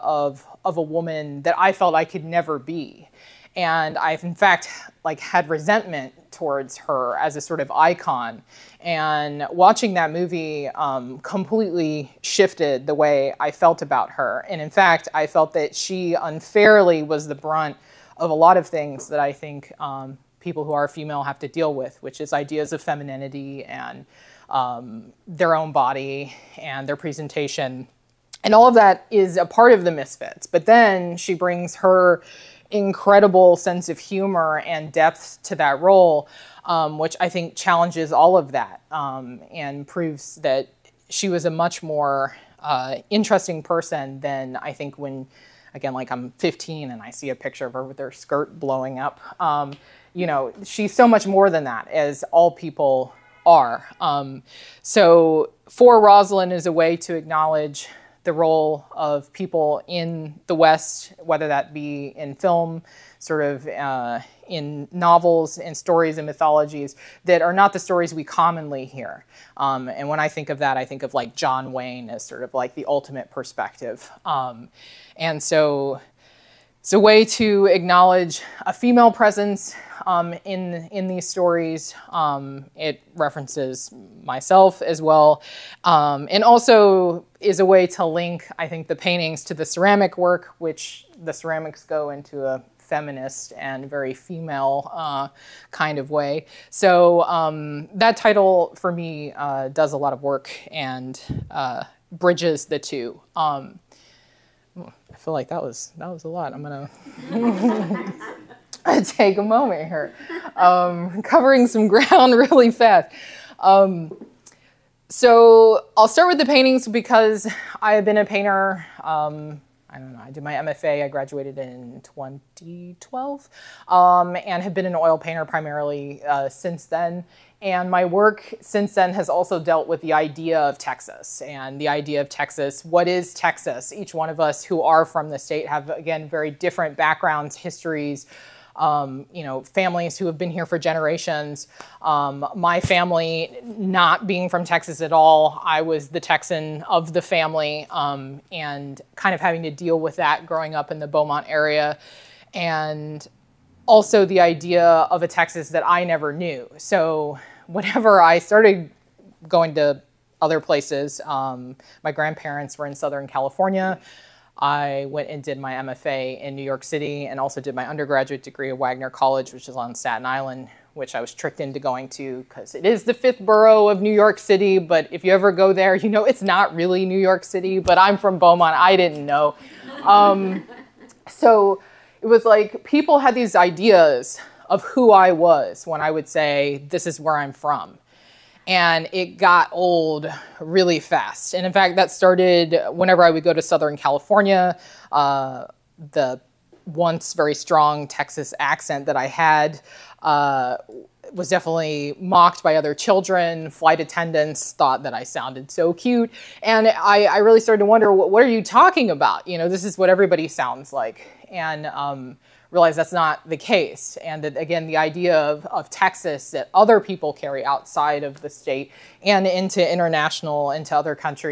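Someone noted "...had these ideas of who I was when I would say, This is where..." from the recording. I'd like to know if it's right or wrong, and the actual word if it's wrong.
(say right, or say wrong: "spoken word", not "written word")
right.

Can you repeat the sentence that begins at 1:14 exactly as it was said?
Um, and so it's a way to acknowledge a female presence um, in in these stories.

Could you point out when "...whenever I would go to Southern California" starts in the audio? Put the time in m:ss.
3:12.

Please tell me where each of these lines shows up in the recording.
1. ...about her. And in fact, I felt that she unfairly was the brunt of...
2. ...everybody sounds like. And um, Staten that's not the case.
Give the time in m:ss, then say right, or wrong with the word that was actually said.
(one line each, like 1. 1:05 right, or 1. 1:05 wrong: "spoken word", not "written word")
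1. 0:13 right
2. 3:30 wrong: "Realize", not "Staten".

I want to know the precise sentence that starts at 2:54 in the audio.
But if you ever go there, you know it's not really New York City, but I'm from Beaumont.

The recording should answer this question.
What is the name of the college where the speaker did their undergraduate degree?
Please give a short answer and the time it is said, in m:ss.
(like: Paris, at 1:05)
Wagner College, at 2:48.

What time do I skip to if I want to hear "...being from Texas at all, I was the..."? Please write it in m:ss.
2:24.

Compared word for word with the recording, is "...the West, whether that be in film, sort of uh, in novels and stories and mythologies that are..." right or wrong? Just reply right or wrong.
right.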